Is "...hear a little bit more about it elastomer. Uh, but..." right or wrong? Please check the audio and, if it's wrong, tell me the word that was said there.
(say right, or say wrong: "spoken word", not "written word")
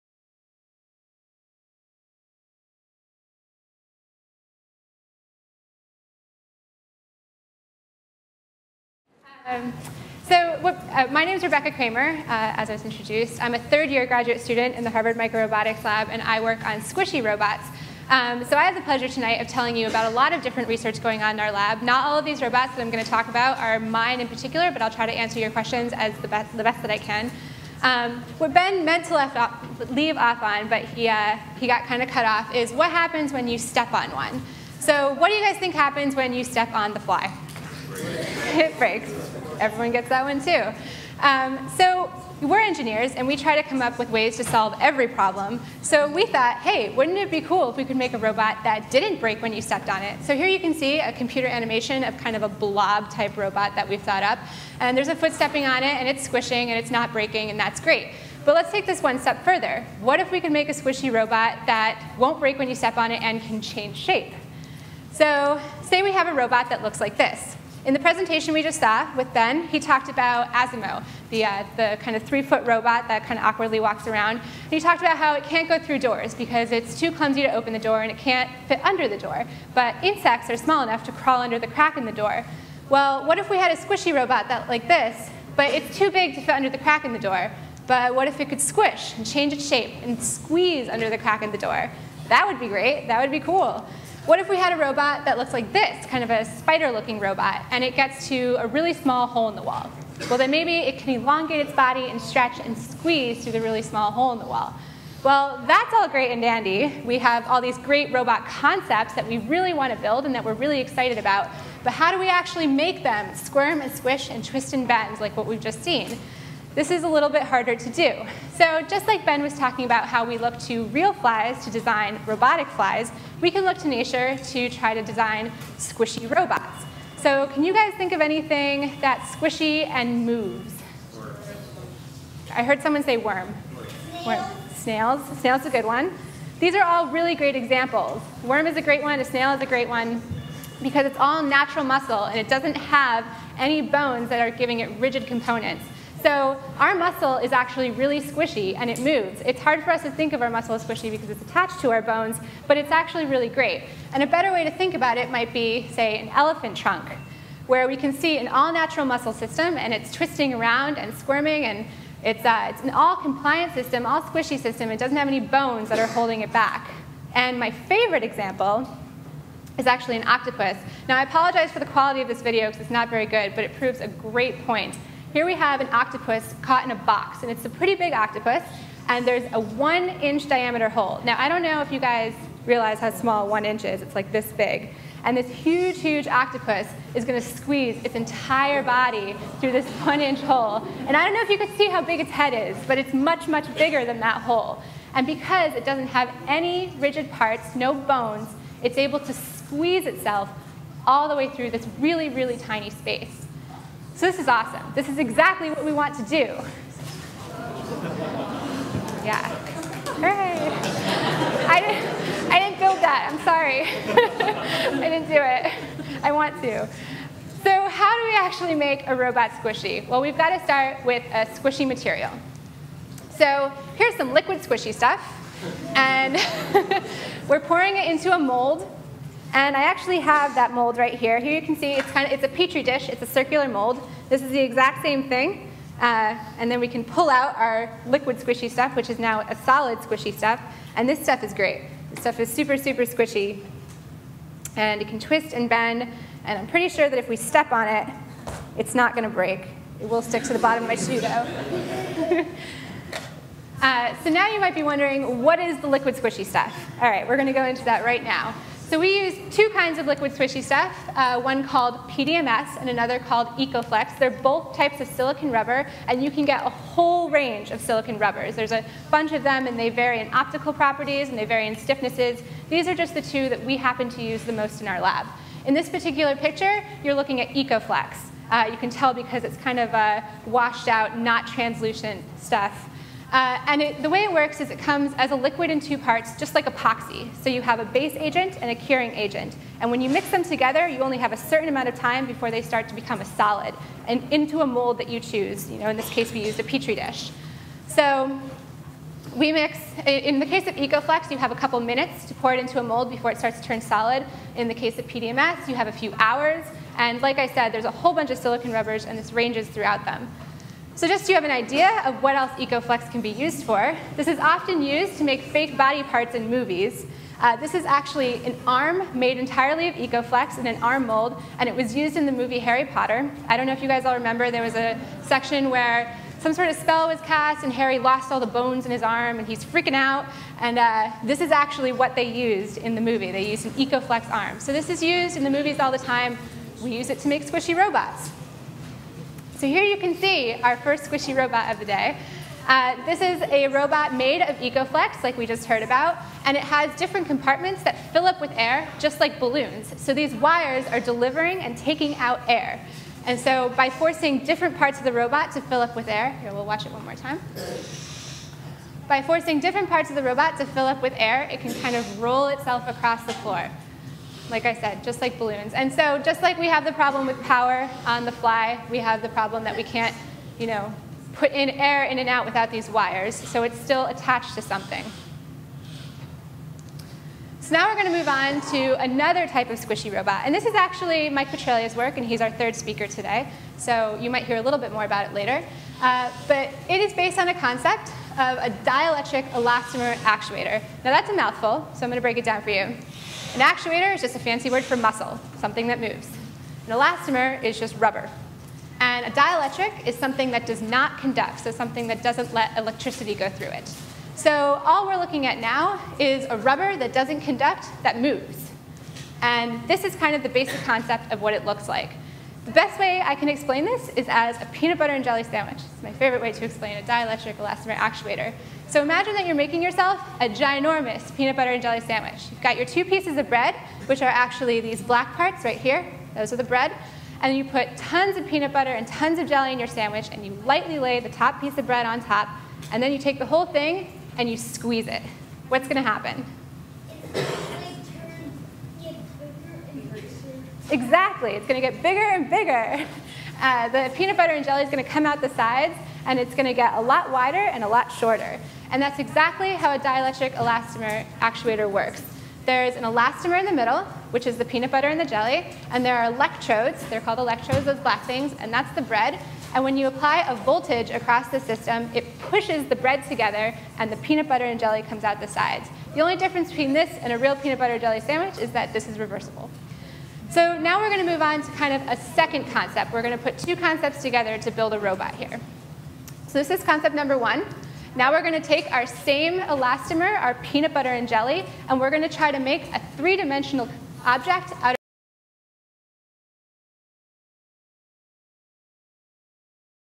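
wrong: "later", not "elastomer".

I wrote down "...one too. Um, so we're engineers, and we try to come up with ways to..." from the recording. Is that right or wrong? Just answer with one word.
right.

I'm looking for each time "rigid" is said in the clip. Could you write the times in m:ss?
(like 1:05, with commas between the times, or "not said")
2:24, 3:16.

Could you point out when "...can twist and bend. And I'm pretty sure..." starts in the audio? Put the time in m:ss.
4:05.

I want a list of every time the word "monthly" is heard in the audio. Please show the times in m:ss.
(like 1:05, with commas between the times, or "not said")
not said.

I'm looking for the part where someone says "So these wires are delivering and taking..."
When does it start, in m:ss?
5:50.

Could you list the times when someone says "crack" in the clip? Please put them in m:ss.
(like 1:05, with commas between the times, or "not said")
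1:21, 1:26, 1:31.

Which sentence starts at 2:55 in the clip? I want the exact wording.
Here we have an octopus caught in a box, and it's a pretty big octopus, and there's a one inch diameter hole.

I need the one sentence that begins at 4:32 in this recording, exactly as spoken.
These are just the two that we happen to use the most in our lab.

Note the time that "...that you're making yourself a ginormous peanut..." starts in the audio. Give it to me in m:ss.
6:59.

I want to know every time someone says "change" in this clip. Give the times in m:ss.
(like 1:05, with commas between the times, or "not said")
1:03, 1:29.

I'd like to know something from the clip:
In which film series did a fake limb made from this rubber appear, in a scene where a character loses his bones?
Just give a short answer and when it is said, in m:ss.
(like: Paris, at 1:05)
Harry Potter, at 5:22.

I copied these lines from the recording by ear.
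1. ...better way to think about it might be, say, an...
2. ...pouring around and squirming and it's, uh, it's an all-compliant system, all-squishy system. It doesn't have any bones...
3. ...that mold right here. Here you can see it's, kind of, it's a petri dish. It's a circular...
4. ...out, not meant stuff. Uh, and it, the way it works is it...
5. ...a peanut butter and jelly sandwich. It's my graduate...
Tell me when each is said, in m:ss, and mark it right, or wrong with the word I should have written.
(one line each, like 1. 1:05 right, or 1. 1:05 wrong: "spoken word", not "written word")
1. 2:34 right
2. 2:40 wrong: "twisting", not "pouring"
3. 3:50 right
4. 4:40 wrong: "translucent", not "meant"
5. 6:54 wrong: "favorite", not "graduate".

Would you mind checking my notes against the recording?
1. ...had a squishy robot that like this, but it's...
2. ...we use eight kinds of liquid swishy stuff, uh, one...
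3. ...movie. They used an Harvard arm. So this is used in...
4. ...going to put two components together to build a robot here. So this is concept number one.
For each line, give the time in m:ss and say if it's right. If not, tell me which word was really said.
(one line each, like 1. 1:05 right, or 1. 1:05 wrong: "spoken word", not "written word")
1. 1:23 right
2. 4:18 wrong: "two", not "eight"
3. 5:33 wrong: "EcoFlex", not "Harvard"
4. 7:53 wrong: "concepts", not "components".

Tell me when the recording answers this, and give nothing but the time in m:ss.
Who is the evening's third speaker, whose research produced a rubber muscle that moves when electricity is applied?
6:21.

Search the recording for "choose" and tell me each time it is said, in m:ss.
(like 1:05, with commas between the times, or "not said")
4:55.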